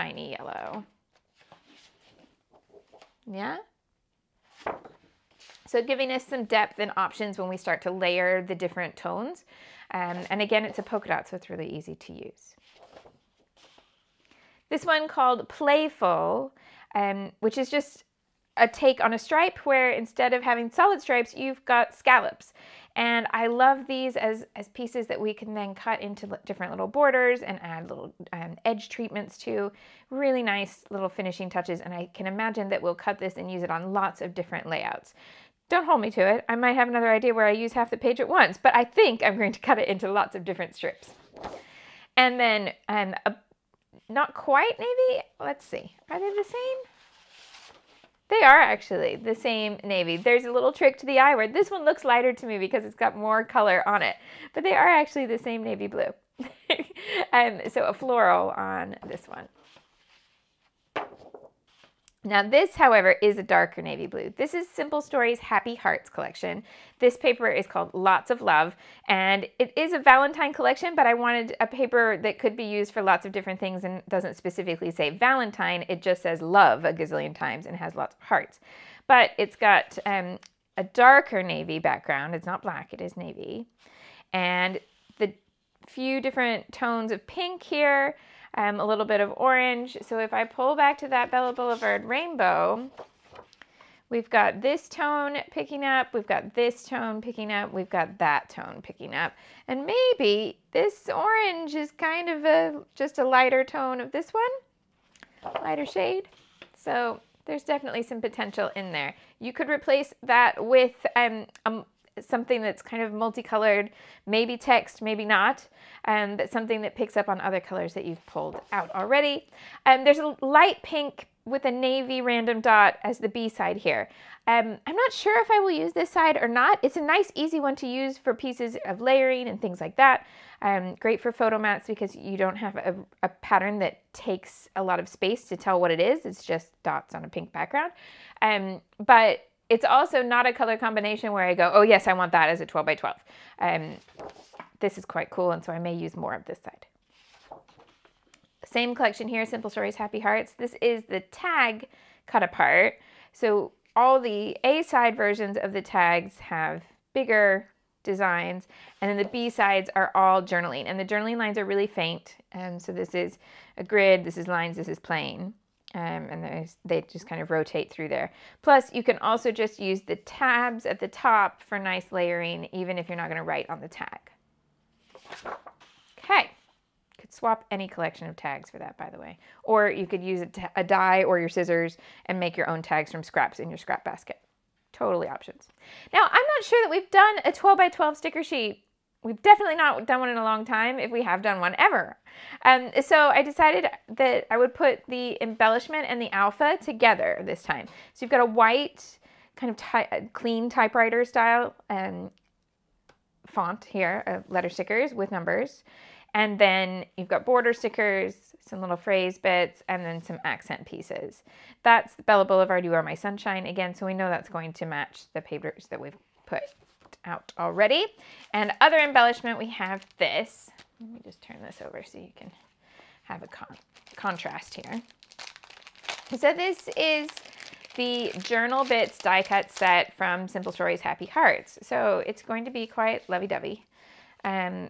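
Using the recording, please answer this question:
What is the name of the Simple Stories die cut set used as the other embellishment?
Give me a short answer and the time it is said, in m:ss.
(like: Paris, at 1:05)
Journal Bits, at 3:48.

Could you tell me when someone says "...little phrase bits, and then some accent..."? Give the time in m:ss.
3:28.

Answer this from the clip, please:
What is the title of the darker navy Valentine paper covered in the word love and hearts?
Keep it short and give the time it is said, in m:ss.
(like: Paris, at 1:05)
Lots of Love, at 1:07.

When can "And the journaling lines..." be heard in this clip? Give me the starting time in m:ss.
2:40.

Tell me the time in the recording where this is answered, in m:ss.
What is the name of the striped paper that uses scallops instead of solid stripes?
0:15.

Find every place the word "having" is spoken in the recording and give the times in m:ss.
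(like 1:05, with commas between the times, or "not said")
0:20.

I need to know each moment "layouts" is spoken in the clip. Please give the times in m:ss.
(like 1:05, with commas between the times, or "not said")
0:34.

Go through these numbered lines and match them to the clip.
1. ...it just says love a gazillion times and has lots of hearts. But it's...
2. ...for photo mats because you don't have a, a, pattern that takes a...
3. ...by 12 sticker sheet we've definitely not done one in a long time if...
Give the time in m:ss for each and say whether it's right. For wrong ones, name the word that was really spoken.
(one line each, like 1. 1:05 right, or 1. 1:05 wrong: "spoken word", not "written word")
1. 1:15 right
2. 2:11 right
3. 3:07 right.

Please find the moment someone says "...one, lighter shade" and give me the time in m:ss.
1:44.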